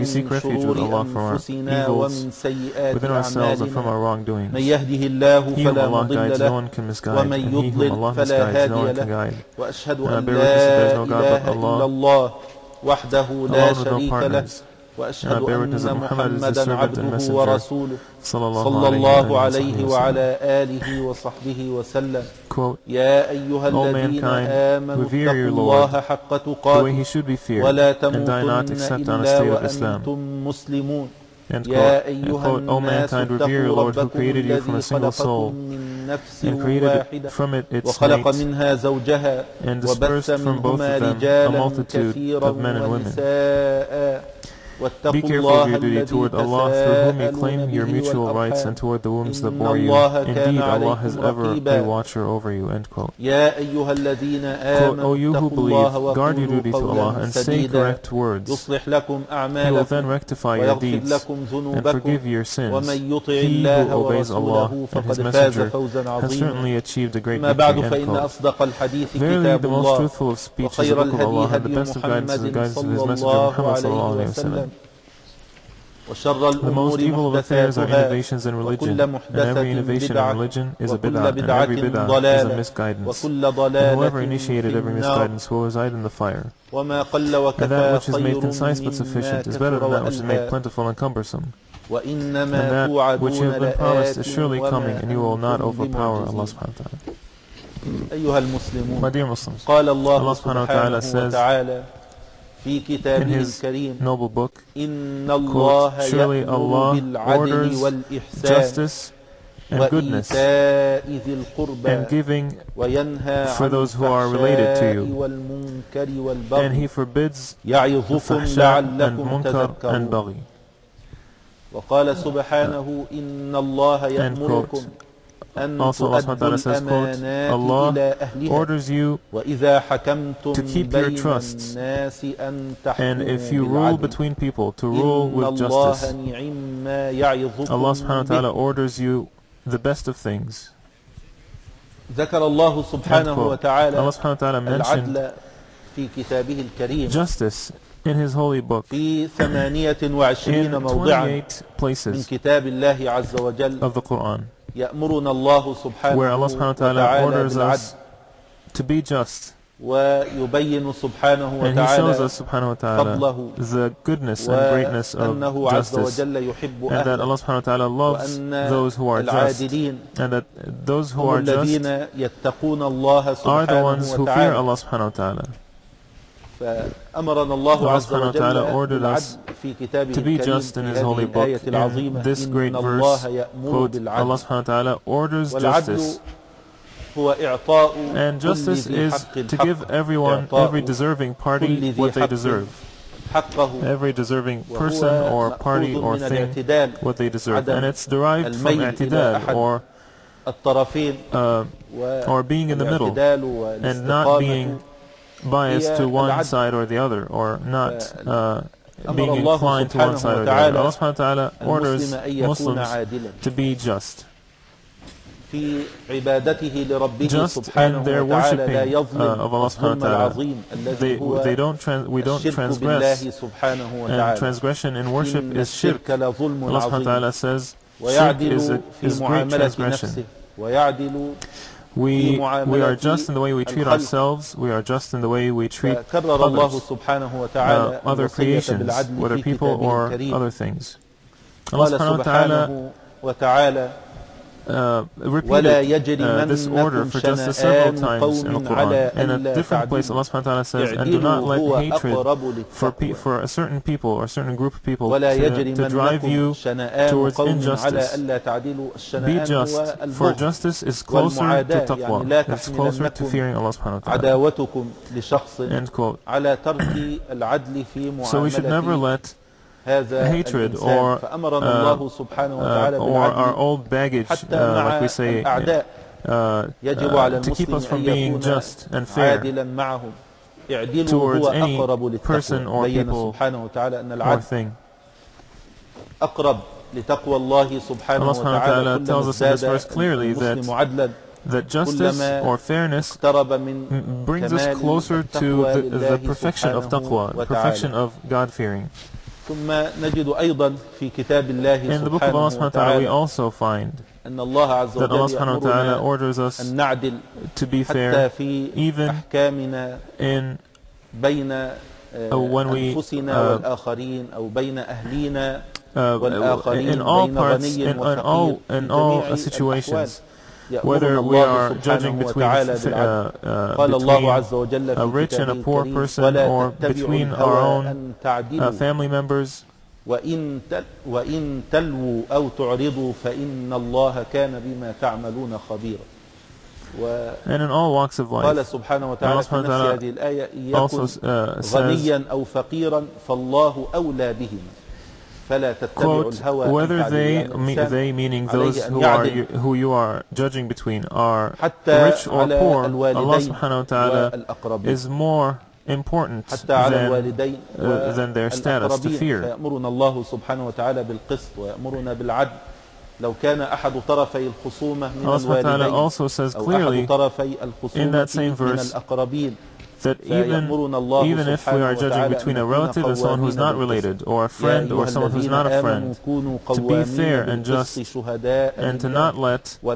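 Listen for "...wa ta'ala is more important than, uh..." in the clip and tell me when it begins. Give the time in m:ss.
5:53.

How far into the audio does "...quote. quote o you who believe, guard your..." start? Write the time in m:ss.
0:52.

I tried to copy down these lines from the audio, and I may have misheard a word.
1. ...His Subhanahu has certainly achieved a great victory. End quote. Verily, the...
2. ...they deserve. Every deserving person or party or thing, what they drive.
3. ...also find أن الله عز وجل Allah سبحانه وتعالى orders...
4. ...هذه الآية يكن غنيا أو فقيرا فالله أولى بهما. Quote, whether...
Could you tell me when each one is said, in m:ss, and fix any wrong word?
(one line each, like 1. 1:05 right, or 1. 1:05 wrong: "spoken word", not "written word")
1. 1:05 wrong: "Messenger", not "Subhanahu"
2. 3:12 wrong: "deserve", not "drive"
3. 5:03 right
4. 5:39 right.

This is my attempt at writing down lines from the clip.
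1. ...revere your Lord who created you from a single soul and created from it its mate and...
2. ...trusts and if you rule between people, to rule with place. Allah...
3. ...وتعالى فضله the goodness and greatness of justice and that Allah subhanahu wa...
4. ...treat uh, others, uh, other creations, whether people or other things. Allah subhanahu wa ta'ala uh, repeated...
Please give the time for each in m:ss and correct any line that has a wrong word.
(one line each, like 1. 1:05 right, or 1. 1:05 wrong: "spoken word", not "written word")
1. 0:33 right
2. 2:11 wrong: "justice", not "place"
3. 2:41 right
4. 3:55 right.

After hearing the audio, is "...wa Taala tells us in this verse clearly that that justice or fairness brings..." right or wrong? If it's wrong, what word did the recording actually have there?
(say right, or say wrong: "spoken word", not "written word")
right.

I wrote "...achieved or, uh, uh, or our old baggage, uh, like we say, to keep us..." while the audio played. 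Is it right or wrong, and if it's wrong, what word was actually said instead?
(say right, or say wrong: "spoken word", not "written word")
wrong: "hatred", not "achieved".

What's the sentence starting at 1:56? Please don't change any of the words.
And he forbids الفحشاء and munkar and baghi.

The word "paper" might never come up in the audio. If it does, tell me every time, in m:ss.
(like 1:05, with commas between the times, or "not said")
not said.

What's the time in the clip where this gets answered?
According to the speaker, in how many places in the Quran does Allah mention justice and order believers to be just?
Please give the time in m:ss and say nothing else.
2:29.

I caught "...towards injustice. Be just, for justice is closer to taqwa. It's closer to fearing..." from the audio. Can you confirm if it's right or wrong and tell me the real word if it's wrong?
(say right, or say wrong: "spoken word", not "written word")
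right.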